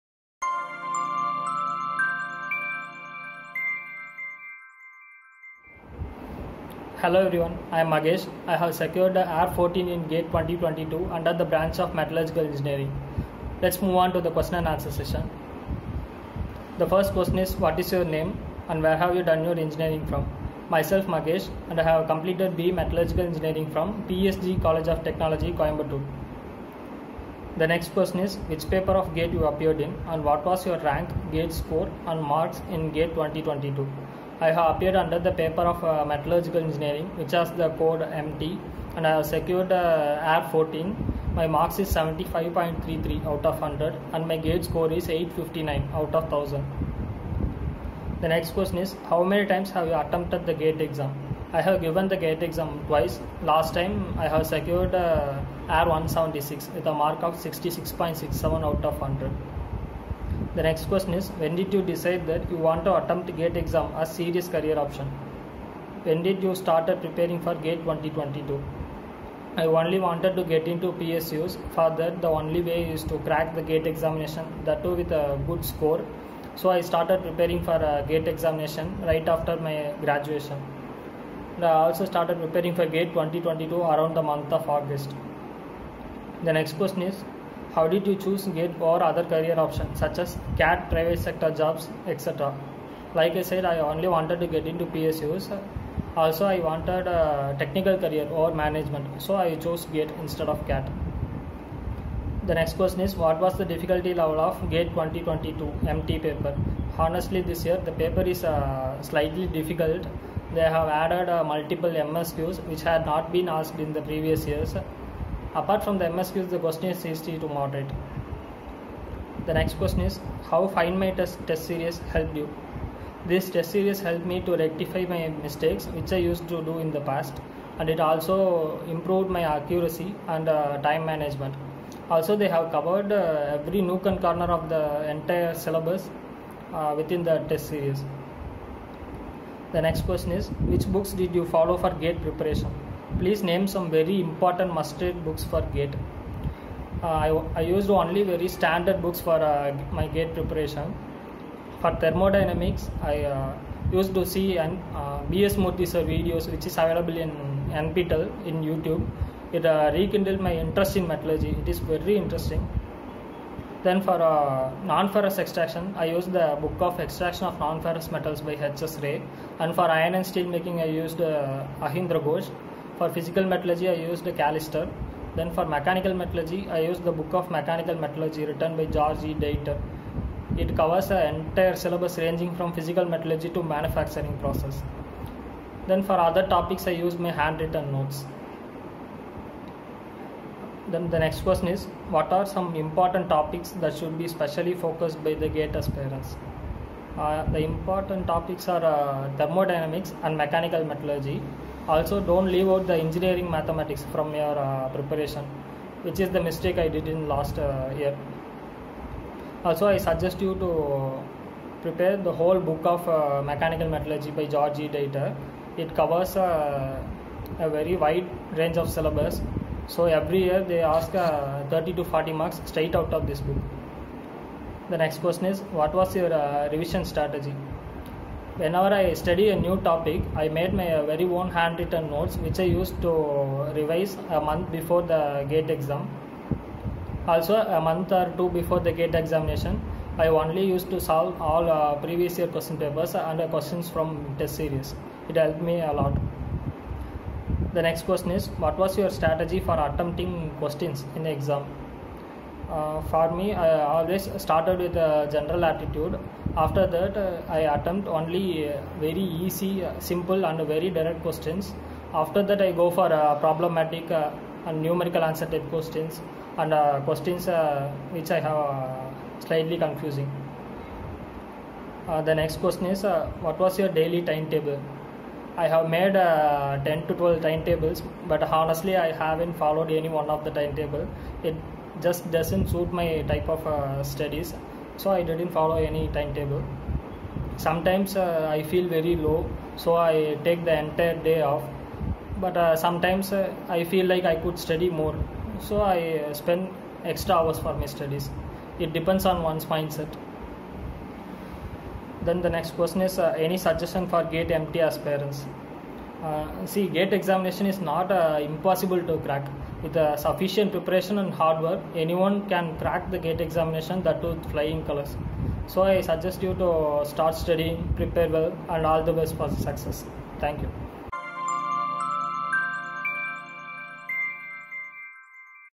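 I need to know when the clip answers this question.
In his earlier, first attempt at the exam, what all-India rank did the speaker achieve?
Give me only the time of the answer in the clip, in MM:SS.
00:55.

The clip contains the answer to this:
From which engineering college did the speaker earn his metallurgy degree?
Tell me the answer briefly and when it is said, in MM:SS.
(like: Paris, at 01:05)
PSG College of Technology, at 00:24.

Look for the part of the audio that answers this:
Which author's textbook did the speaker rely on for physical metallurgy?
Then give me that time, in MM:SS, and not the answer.
02:54.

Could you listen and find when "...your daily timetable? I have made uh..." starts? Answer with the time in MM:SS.
04:33.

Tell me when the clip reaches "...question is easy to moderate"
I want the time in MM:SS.
01:56.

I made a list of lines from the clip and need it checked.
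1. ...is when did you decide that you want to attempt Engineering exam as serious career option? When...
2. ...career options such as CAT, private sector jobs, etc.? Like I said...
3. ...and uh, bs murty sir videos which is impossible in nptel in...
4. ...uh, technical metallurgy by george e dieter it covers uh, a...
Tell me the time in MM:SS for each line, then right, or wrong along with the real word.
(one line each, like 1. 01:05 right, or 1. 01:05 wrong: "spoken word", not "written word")
1. 01:01 wrong: "GATE", not "Engineering"
2. 01:29 right
3. 02:34 wrong: "available", not "impossible"
4. 03:33 wrong: "mechanical", not "technical".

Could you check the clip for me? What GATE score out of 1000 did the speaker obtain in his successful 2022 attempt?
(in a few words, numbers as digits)
859.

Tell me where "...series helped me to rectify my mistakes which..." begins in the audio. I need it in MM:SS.
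02:03.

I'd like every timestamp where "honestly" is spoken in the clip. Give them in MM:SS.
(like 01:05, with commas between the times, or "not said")
01:46, 04:38.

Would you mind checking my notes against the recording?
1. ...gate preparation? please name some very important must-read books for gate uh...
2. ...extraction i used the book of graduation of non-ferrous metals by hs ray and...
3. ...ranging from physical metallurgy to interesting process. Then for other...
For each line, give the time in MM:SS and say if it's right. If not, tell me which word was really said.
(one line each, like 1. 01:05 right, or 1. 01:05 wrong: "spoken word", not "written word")
1. 02:21 right
2. 02:45 wrong: "extraction", not "graduation"
3. 03:02 wrong: "manufacturing", not "interesting".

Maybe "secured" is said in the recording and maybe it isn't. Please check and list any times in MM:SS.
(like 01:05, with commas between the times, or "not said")
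00:08, 00:39, 00:54.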